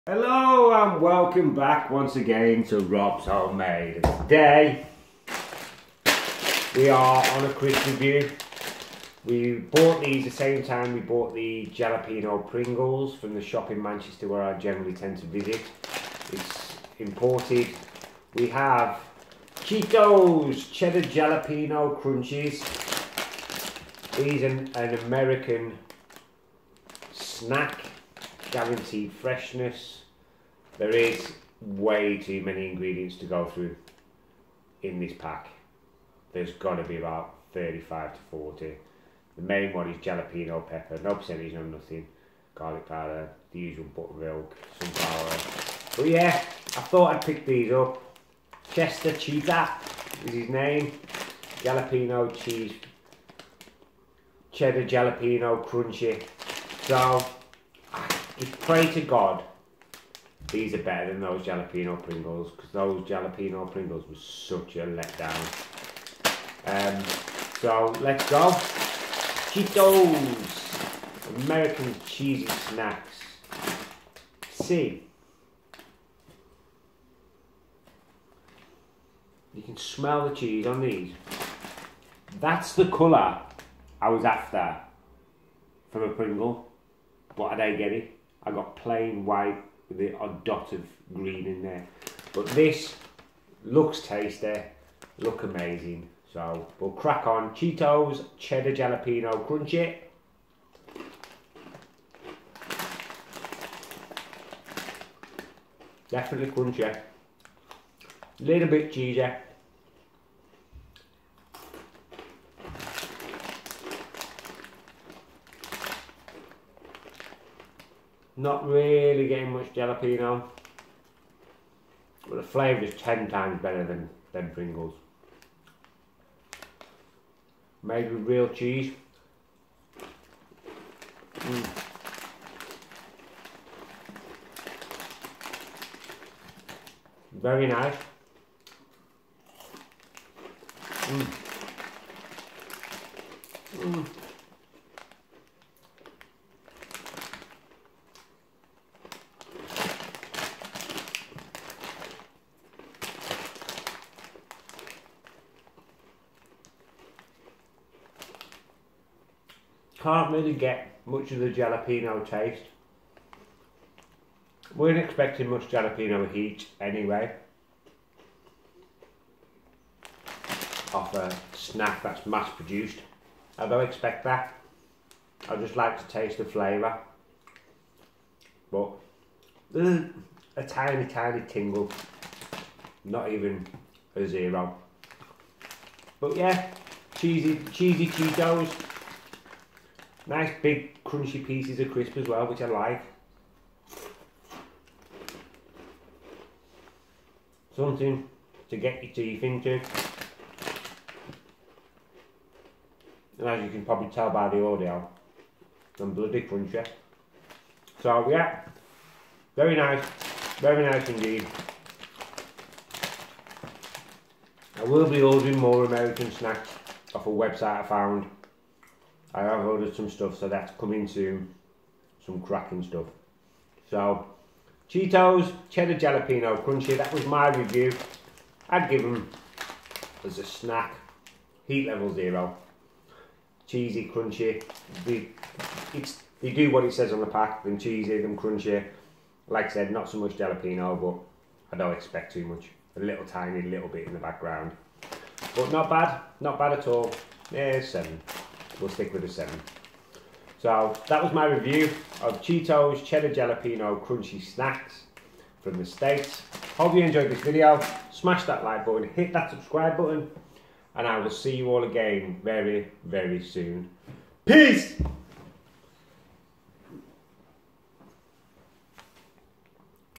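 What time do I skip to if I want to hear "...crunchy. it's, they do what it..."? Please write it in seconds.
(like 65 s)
234 s.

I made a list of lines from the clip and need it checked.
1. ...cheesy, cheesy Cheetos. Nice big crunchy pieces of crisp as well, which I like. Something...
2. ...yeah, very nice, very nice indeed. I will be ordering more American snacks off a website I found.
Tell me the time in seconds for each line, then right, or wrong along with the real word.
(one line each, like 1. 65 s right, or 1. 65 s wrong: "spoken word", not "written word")
1. 187 s right
2. 208 s right.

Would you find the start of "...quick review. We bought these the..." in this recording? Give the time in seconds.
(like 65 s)
7 s.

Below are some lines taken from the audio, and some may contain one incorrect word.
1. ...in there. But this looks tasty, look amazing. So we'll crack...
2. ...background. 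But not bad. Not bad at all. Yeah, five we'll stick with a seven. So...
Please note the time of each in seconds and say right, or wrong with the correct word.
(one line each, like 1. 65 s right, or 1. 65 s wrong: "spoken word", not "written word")
1. 91 s right
2. 244 s wrong: "seven", not "five".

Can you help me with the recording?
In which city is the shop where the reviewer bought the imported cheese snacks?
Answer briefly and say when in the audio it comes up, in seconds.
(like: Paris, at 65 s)
Manchester, at 13 s.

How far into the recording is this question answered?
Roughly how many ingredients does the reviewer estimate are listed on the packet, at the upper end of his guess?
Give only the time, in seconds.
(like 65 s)
38 s.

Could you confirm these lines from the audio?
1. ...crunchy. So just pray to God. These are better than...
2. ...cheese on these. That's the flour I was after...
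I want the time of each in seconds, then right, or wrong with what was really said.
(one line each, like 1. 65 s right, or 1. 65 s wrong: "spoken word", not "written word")
1. 55 s right
2. 80 s wrong: "colour", not "flour".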